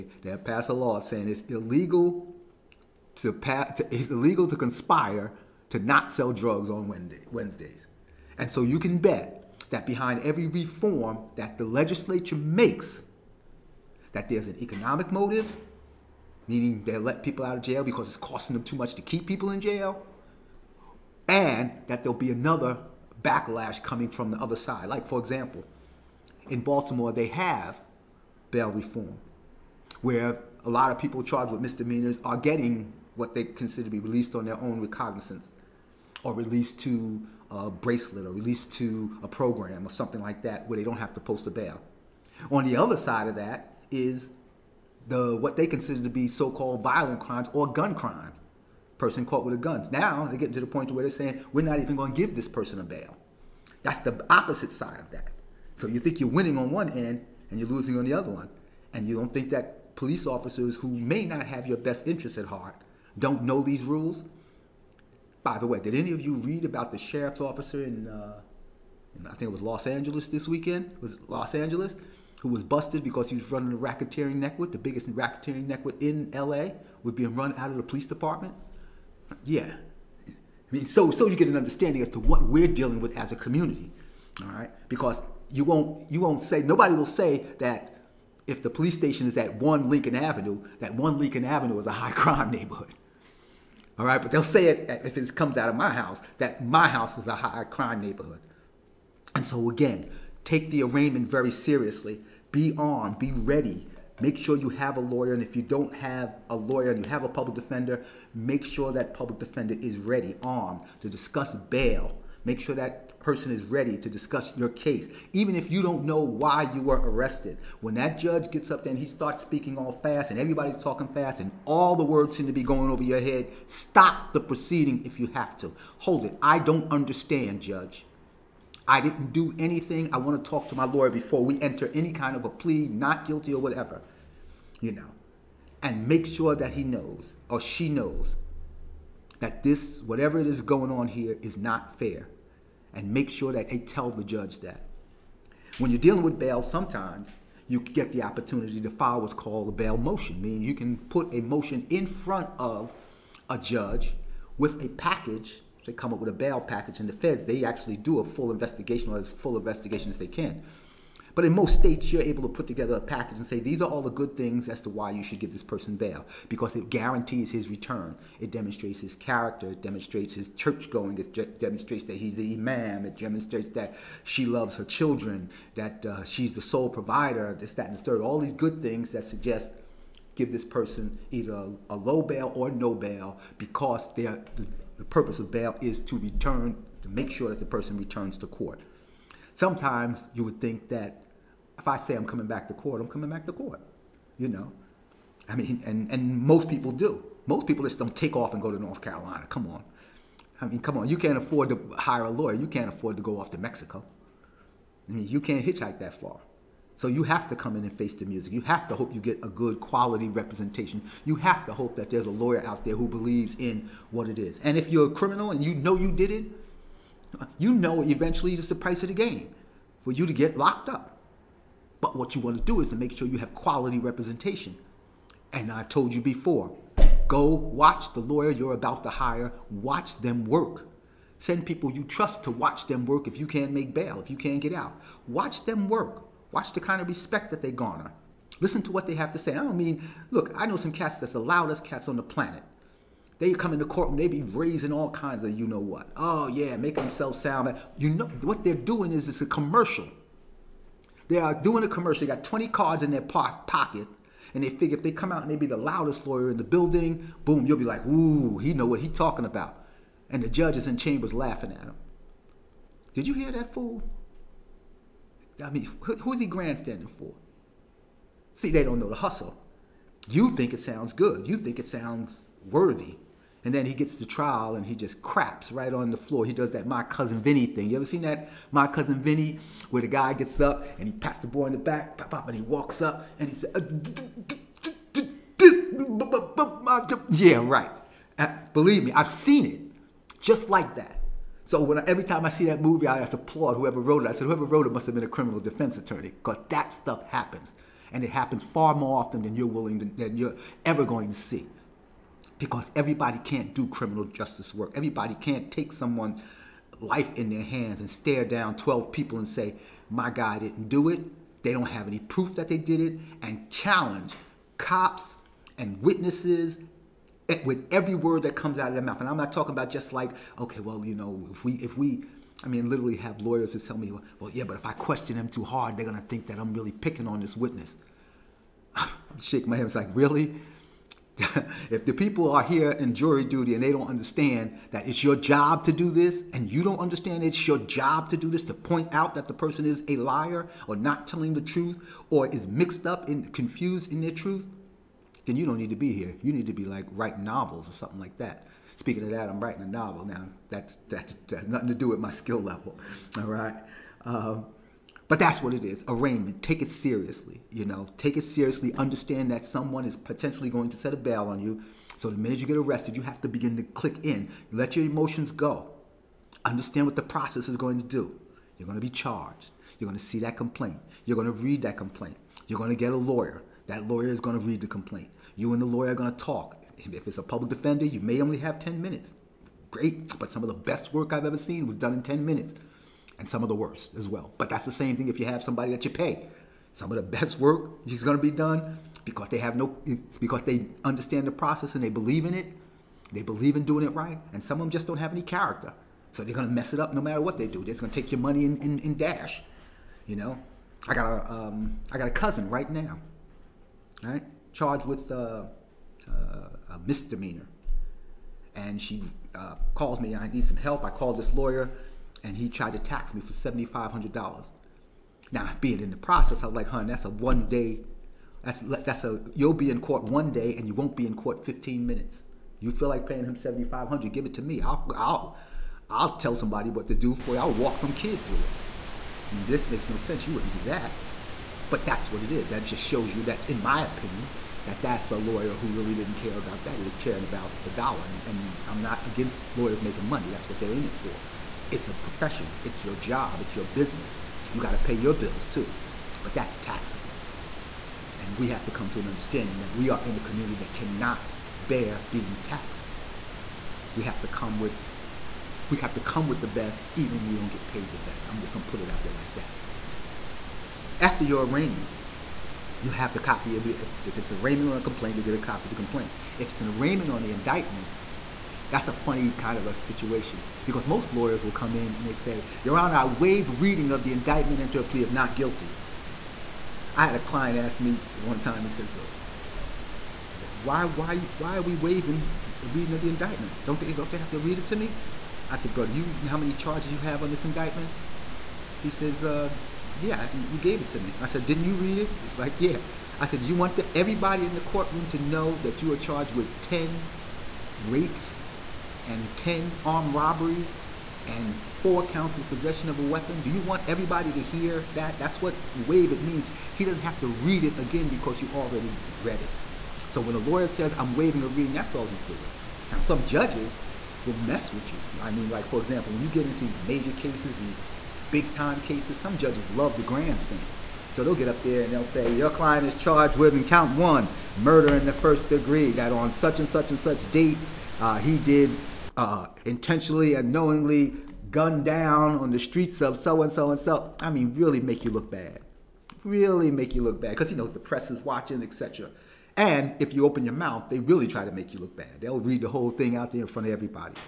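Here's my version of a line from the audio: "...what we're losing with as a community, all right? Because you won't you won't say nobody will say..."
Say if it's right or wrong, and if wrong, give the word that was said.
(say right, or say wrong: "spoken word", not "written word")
wrong: "dealing", not "losing".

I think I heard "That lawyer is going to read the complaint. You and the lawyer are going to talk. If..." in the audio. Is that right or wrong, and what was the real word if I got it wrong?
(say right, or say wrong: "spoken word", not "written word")
right.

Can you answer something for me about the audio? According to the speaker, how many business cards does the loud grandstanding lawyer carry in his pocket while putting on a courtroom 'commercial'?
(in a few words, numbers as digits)
20.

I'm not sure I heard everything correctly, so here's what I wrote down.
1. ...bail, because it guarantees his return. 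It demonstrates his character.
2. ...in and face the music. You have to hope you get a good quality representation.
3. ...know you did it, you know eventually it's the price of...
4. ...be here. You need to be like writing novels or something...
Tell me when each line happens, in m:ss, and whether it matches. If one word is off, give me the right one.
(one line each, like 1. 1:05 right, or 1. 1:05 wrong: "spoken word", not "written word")
1. 2:45 right
2. 3:27 right
3. 3:35 right
4. 5:45 right.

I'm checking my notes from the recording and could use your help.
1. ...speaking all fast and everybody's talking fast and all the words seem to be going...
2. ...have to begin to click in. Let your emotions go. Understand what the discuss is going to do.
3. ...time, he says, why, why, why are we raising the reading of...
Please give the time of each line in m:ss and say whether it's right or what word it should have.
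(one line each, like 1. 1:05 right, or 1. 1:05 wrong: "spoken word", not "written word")
1. 1:59 right
2. 6:03 wrong: "process", not "discuss"
3. 7:58 wrong: "waiving", not "raising".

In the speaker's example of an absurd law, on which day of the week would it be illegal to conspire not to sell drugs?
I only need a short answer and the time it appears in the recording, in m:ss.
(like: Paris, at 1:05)
Wednesday, at 0:06.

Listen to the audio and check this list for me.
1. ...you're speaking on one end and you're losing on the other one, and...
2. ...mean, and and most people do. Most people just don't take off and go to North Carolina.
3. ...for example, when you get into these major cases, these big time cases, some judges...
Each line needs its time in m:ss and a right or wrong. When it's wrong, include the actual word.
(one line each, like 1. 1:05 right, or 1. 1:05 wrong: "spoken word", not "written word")
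1. 0:56 wrong: "winning", not "speaking"
2. 3:15 right
3. 8:35 right.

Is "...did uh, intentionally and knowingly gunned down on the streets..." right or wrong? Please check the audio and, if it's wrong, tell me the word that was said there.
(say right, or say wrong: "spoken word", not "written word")
right.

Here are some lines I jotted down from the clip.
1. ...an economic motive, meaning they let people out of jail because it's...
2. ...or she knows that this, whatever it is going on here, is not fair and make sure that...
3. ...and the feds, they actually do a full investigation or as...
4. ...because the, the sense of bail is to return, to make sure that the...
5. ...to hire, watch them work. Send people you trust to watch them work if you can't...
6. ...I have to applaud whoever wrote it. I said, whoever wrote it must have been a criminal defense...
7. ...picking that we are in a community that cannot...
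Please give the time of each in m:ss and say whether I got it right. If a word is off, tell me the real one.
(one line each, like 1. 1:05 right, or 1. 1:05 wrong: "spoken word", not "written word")
1. 0:14 right
2. 2:17 right
3. 2:37 right
4. 3:03 wrong: "purpose", not "sense"
5. 3:49 right
6. 4:53 right
7. 7:29 wrong: "understanding", not "picking".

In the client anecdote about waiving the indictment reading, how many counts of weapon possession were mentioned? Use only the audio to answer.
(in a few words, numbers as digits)
4.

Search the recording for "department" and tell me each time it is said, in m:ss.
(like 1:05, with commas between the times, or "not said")
1:18.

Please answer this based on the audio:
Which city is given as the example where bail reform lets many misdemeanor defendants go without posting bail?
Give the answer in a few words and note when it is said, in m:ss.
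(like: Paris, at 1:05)
Baltimore, at 0:26.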